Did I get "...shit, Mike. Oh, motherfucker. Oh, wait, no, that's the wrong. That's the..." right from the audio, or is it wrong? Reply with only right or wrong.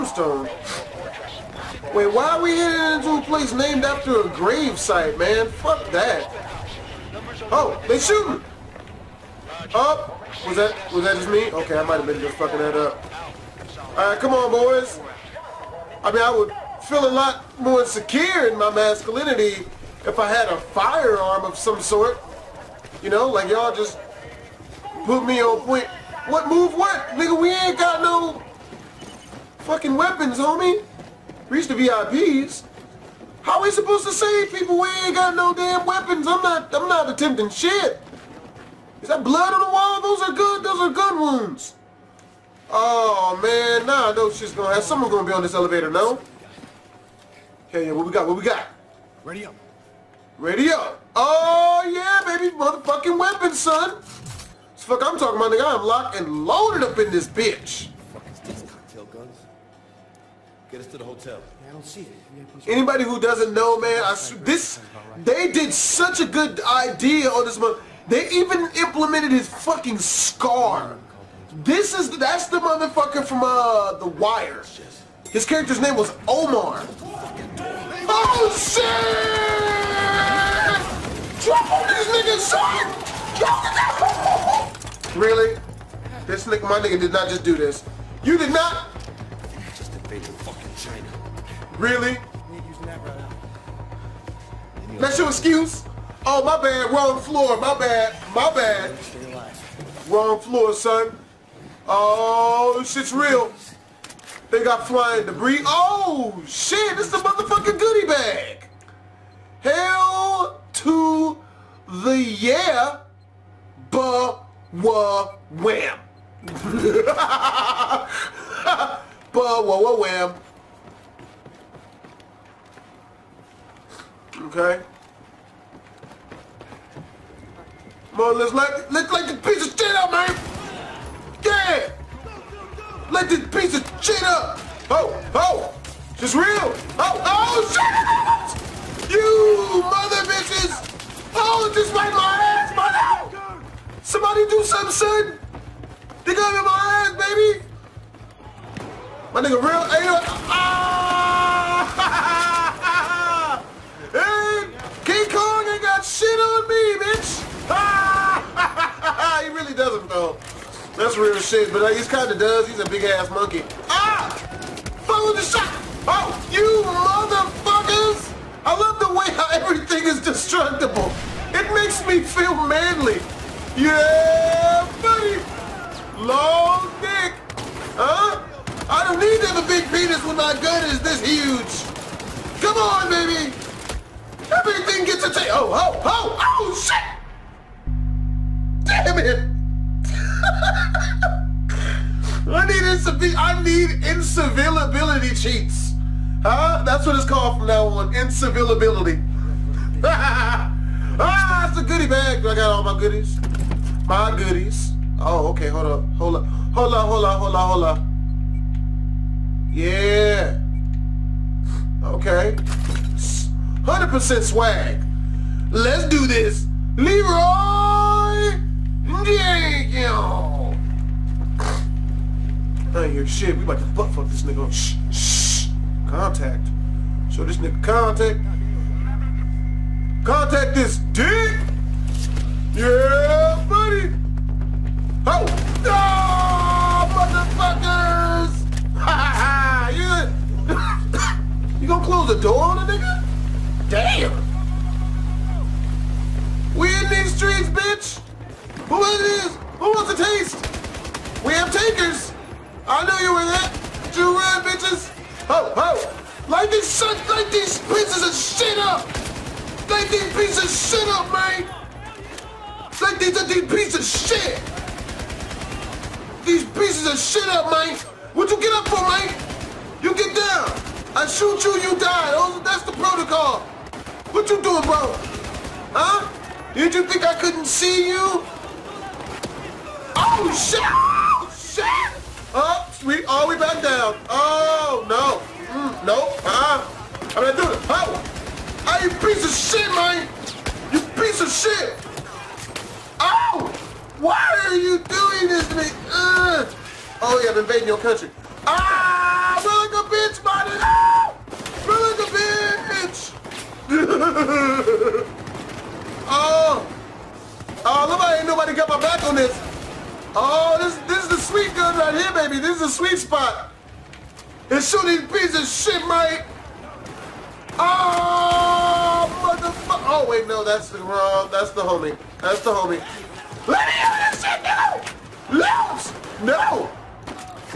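right.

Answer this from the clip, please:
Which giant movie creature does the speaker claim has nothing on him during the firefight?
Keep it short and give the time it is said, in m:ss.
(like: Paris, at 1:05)
King Kong, at 2:35.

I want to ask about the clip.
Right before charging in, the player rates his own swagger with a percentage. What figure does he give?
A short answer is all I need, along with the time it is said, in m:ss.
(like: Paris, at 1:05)
100%, at 3:32.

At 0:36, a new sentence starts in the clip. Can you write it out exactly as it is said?
I'm not I'm not attempting shit.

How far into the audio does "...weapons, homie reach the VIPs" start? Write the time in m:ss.
0:29.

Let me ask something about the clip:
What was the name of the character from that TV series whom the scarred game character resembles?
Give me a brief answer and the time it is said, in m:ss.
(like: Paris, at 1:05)
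Omar, at 1:16.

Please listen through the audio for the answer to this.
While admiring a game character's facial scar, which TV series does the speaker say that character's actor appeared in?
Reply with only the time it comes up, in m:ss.
1:13.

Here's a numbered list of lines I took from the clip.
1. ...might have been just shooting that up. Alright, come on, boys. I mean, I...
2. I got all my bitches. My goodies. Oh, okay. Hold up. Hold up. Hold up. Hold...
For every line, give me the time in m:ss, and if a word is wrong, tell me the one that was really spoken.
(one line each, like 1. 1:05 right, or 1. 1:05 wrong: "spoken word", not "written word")
1. 0:11 wrong: "fucking", not "shooting"
2. 3:22 wrong: "goodies", not "bitches".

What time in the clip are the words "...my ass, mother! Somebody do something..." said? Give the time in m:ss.
2:22.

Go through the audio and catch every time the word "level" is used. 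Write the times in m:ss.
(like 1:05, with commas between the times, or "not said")
not said.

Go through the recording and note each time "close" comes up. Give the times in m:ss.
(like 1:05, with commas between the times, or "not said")
4:02.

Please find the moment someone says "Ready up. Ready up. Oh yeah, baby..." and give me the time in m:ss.
0:49.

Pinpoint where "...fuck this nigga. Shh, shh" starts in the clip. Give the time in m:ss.
3:44.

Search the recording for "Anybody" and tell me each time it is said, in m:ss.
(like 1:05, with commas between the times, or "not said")
1:02.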